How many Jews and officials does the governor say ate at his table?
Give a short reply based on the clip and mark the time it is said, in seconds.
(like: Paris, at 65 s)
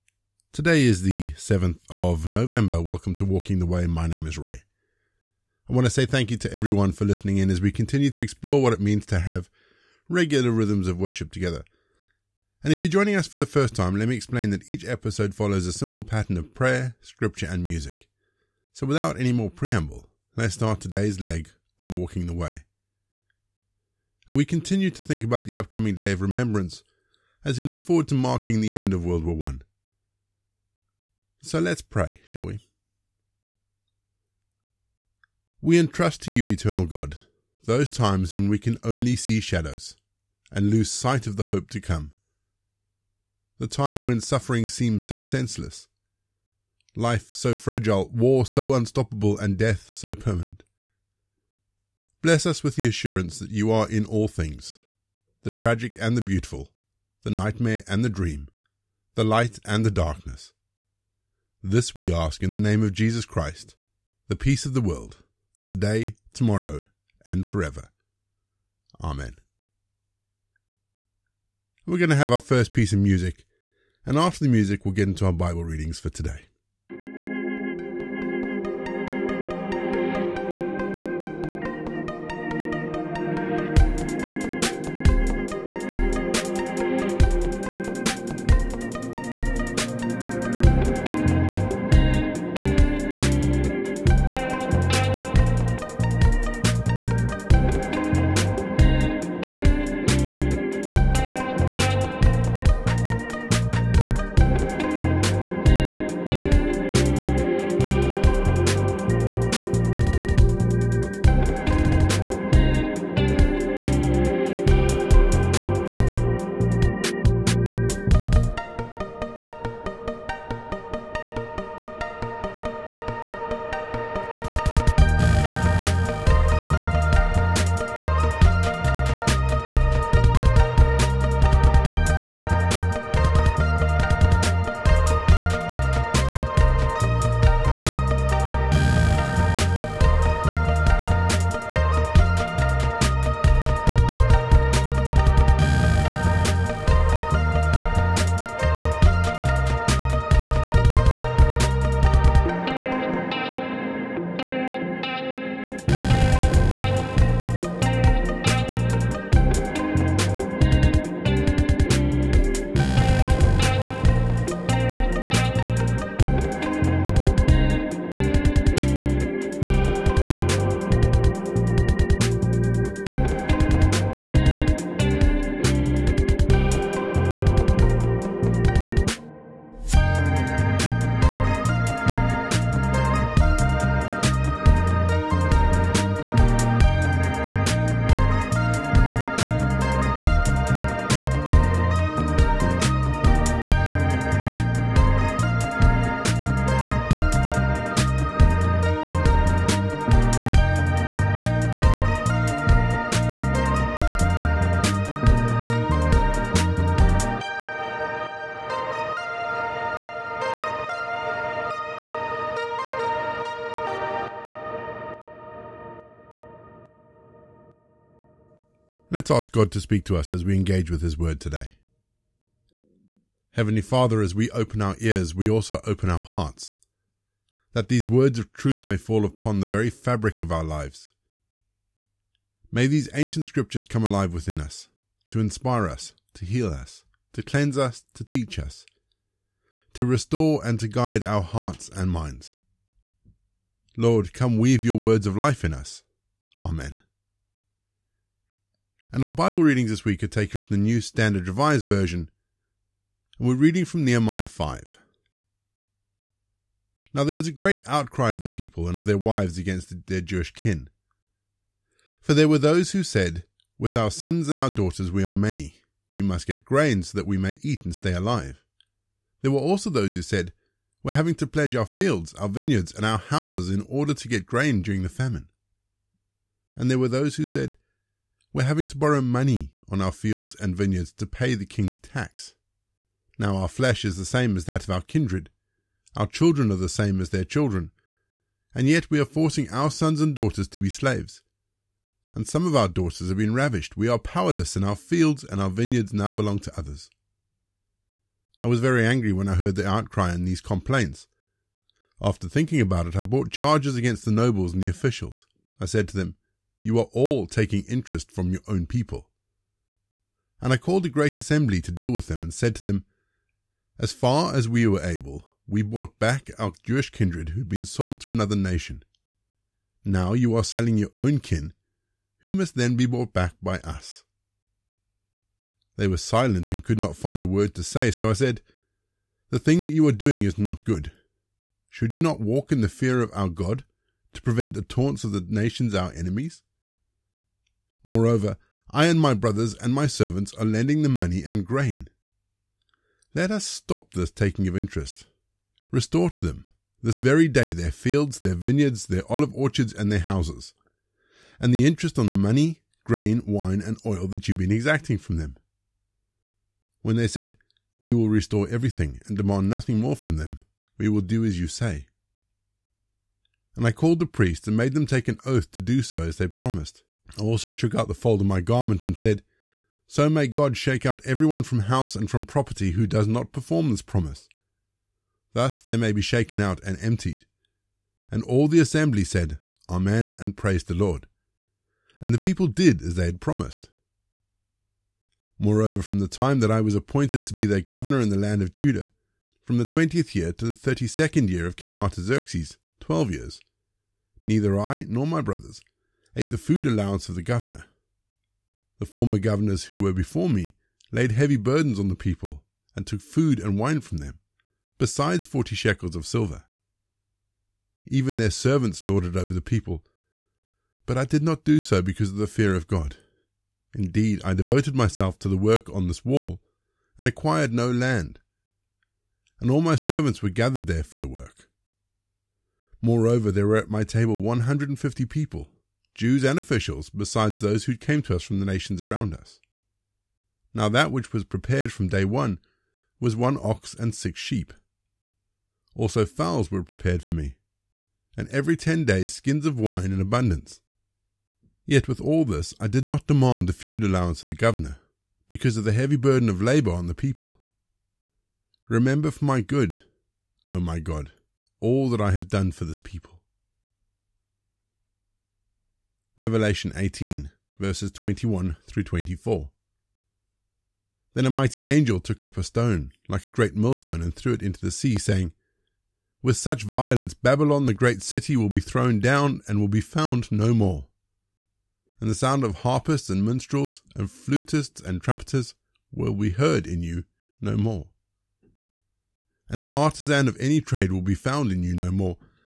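150, at 424 s.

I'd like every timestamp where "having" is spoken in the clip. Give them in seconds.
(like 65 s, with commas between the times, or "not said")
271 s, 278 s.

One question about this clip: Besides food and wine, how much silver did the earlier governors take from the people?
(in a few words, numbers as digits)
40 shekels.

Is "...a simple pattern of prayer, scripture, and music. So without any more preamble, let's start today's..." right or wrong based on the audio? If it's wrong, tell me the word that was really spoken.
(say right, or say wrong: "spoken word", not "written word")
right.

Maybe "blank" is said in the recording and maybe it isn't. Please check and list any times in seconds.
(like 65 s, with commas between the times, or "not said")
not said.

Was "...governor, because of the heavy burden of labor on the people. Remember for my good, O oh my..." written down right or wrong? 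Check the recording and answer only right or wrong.
right.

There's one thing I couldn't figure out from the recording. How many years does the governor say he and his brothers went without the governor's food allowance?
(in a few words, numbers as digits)
12.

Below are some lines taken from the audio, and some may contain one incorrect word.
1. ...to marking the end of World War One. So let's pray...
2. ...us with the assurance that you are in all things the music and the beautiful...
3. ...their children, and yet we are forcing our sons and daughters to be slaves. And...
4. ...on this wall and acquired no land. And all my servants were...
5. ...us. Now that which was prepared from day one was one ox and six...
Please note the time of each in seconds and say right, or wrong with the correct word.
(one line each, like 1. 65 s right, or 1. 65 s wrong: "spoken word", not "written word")
1. 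28 s right
2. 52 s wrong: "tragic", not "music"
3. 287 s right
4. 415 s right
5. 429 s right.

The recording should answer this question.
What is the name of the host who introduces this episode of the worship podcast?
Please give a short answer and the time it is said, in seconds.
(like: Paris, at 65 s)
Ray, at 4 s.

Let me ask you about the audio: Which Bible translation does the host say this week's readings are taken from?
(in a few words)
New Standard Revised Version.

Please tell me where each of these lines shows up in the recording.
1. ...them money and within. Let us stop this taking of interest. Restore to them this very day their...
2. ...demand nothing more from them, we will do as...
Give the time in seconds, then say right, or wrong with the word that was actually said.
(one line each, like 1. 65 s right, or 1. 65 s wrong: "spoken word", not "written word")
1. 341 s wrong: "grain", not "within"
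2. 359 s right.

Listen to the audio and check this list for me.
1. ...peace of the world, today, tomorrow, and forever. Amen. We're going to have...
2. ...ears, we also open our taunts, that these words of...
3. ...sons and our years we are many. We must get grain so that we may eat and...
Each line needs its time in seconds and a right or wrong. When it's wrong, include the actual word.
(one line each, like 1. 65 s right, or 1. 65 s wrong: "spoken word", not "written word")
1. 64 s right
2. 224 s wrong: "hearts", not "taunts"
3. 264 s wrong: "daughters", not "years".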